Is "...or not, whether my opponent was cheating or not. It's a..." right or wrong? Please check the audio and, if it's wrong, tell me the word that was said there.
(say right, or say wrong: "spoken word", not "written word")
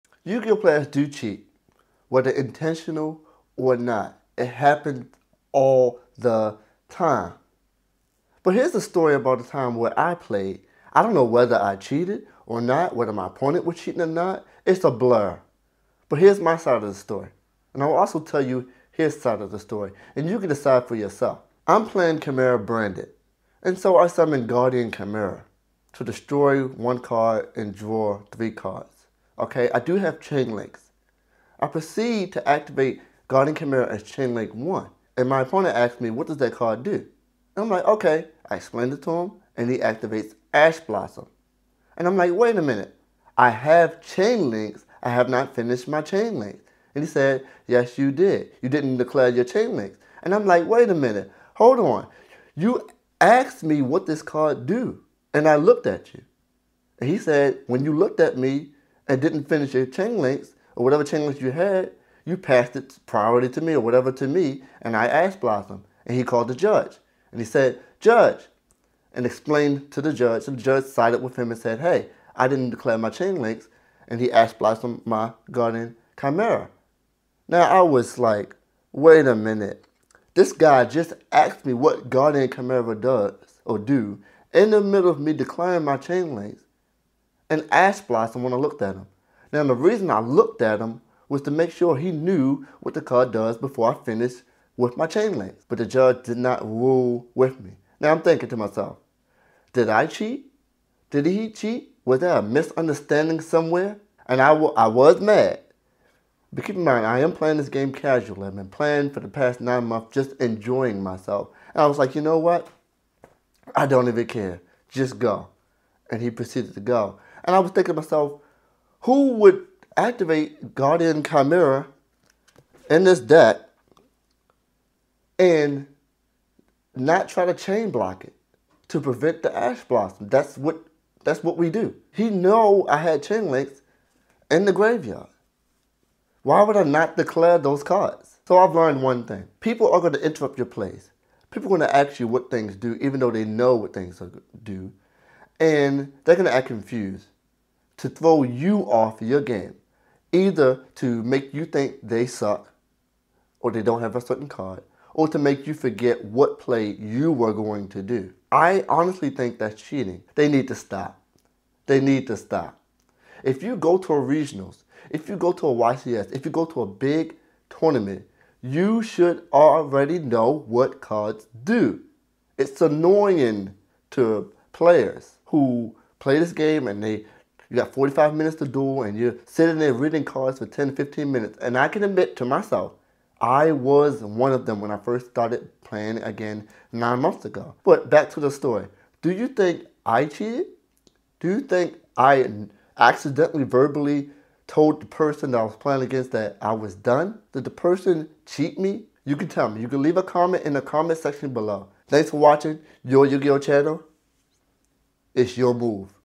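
right.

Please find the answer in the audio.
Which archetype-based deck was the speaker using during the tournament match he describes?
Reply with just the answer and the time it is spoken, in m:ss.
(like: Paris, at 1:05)
Chimera Branded, at 0:22.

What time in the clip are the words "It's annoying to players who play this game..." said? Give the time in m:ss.
2:52.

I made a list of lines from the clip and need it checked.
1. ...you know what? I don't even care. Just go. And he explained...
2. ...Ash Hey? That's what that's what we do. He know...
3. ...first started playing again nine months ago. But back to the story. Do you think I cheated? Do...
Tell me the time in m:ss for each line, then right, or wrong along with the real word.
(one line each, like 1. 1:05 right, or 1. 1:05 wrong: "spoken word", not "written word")
1. 1:52 wrong: "proceeded", not "explained"
2. 2:09 wrong: "Blossom", not "Hey"
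3. 3:04 right.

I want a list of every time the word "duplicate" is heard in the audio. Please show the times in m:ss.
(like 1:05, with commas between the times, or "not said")
not said.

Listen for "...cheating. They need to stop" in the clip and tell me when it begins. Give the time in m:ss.
2:39.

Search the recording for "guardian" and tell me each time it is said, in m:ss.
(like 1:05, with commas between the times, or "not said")
0:24, 0:33, 1:15, 1:22, 2:00.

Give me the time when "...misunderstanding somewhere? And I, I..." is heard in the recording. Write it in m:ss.
1:42.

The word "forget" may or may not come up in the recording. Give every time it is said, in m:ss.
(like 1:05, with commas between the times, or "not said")
2:35.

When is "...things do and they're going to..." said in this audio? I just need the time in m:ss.
2:23.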